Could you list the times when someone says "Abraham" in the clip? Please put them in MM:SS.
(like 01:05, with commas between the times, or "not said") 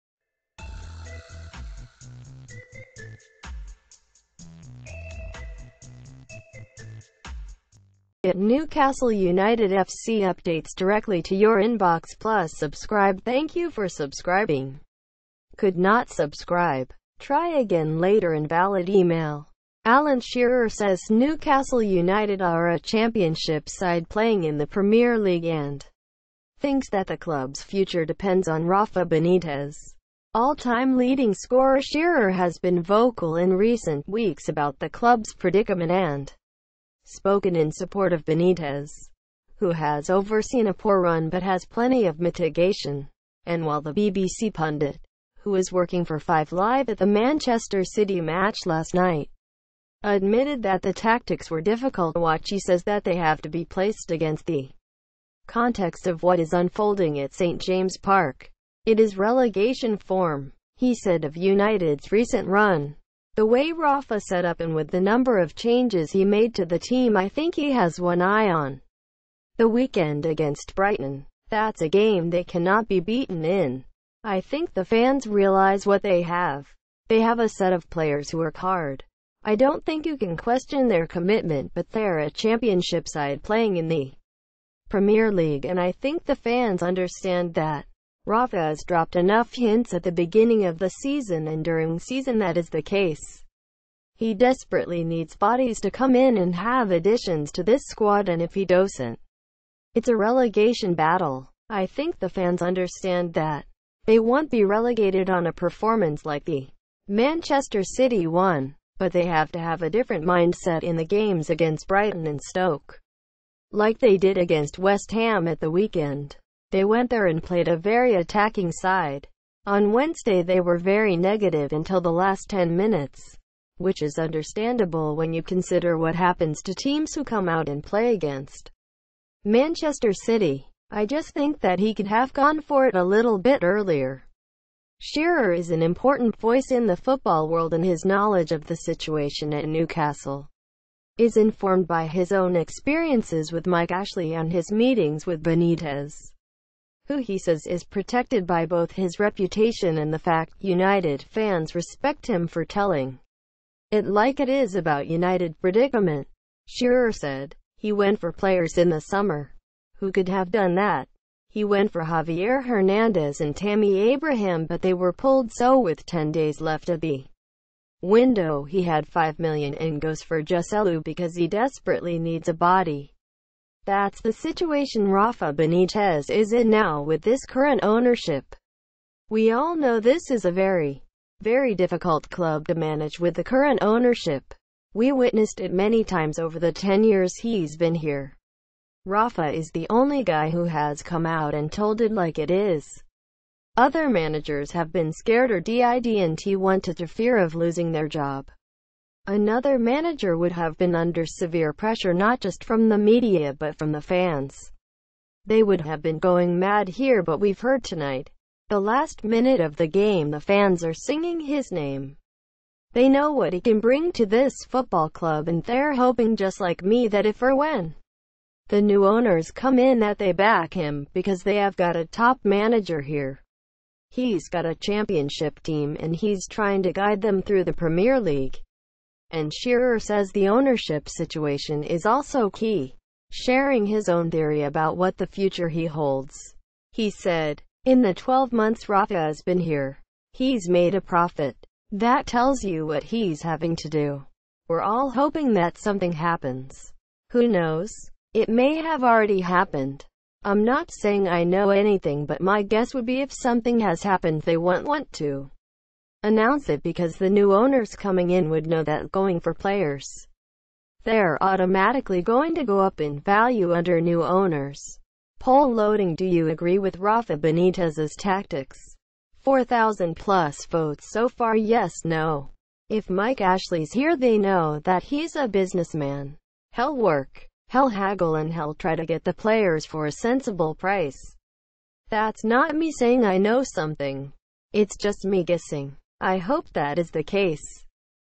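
02:43.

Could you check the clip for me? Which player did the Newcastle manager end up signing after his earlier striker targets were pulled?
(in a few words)
Joselu.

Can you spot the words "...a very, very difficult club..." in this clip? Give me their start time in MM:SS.
03:00.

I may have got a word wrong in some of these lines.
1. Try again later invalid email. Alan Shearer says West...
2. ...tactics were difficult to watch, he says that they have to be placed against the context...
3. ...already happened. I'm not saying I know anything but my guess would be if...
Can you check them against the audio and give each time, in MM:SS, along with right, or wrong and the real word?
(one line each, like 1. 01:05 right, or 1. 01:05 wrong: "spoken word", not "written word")
1. 00:17 wrong: "Newcastle", not "West"
2. 00:50 right
3. 04:09 right.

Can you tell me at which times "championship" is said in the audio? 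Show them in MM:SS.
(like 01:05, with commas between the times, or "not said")
00:22, 01:22, 03:44.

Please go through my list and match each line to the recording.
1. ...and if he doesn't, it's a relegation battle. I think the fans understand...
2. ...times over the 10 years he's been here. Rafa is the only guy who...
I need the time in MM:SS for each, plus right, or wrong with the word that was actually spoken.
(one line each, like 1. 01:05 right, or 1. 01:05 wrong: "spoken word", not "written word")
1. 01:38 right
2. 03:06 right.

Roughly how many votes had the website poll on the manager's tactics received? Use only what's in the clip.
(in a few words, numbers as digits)
4,000 plus.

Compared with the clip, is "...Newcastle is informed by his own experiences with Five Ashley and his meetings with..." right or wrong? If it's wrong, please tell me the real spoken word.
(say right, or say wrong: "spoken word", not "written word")
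wrong: "Mike", not "Five".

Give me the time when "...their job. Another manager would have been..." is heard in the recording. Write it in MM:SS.
03:17.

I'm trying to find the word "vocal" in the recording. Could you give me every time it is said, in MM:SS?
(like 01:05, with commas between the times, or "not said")
00:32.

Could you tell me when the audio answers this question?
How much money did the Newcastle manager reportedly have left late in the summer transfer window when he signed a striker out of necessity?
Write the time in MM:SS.
02:49.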